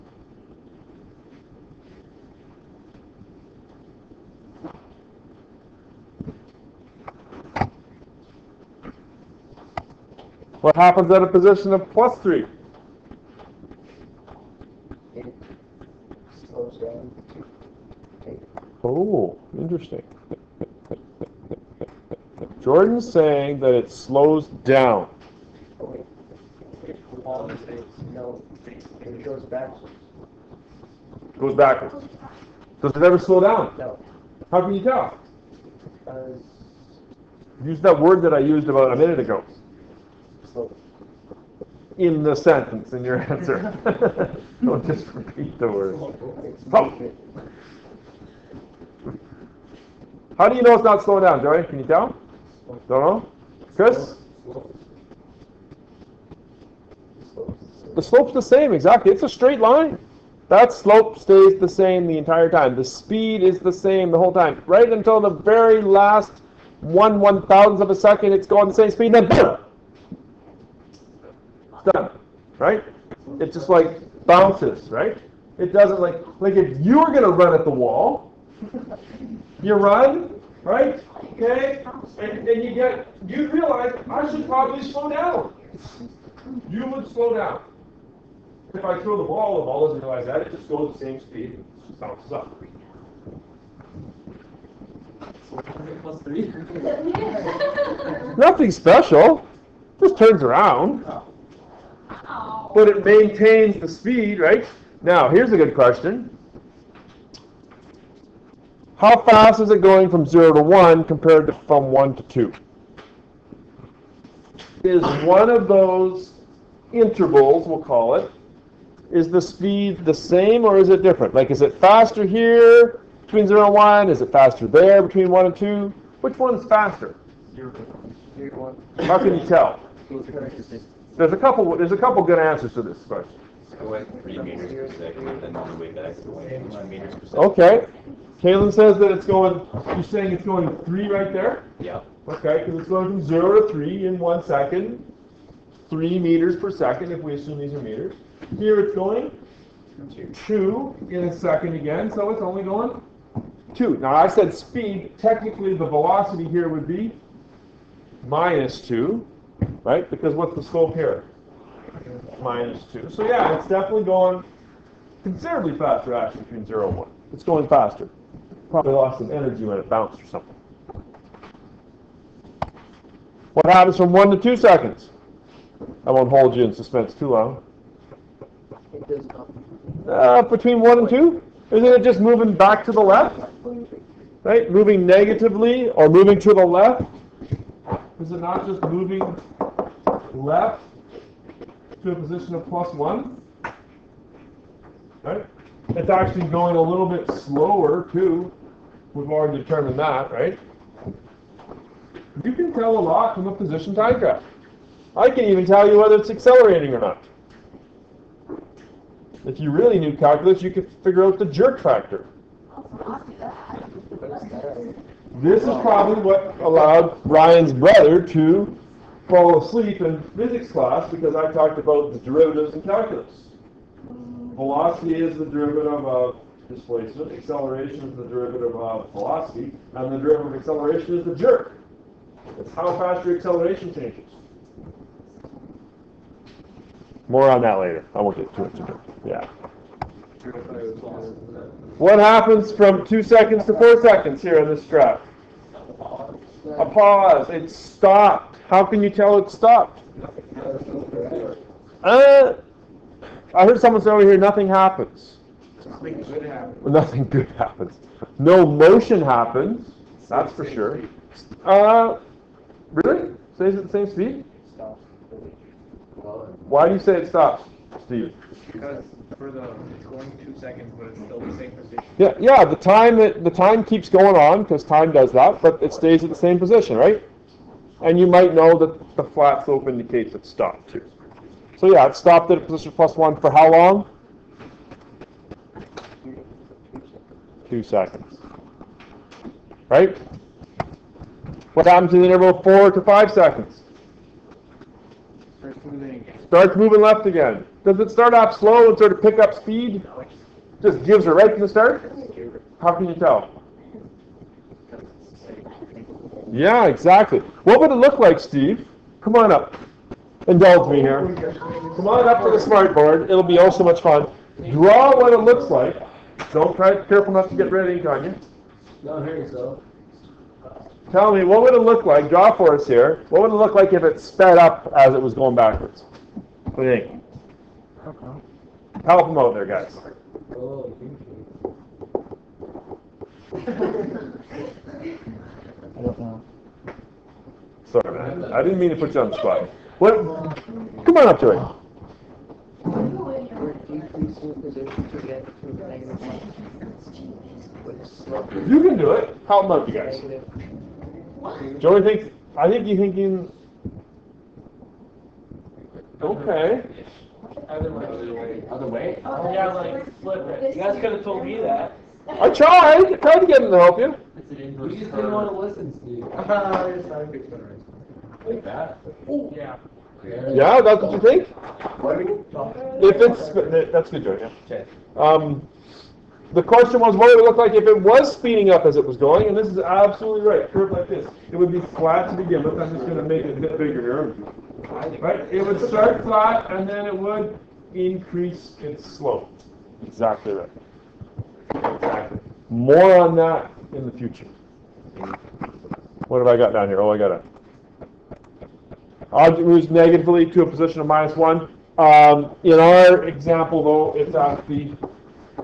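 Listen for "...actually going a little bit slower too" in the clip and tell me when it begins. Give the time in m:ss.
3:16.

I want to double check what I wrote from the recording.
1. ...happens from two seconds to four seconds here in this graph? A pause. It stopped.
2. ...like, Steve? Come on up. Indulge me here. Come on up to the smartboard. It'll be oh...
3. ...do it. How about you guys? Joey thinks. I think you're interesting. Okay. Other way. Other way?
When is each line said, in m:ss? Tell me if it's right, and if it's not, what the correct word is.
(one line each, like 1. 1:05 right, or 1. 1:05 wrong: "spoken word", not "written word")
1. 4:02 right
2. 5:08 right
3. 5:48 wrong: "thinking", not "interesting".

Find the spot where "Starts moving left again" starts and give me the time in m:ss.
4:56.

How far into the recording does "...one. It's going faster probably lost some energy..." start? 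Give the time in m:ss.
2:46.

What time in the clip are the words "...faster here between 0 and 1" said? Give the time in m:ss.
2:01.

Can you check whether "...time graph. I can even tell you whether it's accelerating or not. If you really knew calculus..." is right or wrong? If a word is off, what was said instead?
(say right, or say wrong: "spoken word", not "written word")
right.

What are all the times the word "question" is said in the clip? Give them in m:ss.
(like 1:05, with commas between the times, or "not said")
1:45, 2:13, 6:16.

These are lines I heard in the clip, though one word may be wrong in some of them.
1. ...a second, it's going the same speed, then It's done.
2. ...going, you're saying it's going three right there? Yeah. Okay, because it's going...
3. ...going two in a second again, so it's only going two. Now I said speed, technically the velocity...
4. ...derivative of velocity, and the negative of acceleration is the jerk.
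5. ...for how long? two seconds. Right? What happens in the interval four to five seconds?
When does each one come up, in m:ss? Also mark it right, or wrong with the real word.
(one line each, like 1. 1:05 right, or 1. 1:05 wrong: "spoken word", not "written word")
1. 1:07 right
2. 2:19 right
3. 2:28 right
4. 3:48 wrong: "derivative", not "negative"
5. 4:43 right.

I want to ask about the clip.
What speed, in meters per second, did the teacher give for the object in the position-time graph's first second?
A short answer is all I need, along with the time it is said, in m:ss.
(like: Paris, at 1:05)
3, at 2:25.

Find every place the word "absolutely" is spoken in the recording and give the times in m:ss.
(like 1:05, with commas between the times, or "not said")
6:19.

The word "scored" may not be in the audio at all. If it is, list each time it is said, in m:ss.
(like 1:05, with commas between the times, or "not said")
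not said.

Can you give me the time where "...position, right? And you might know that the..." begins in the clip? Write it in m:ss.
4:36.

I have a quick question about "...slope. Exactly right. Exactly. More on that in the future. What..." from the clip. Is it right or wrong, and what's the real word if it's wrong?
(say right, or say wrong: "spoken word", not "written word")
right.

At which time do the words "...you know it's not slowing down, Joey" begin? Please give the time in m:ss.
0:50.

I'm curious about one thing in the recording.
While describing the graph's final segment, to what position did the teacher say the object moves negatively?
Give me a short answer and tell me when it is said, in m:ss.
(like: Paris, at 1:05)
-1, at 6:41.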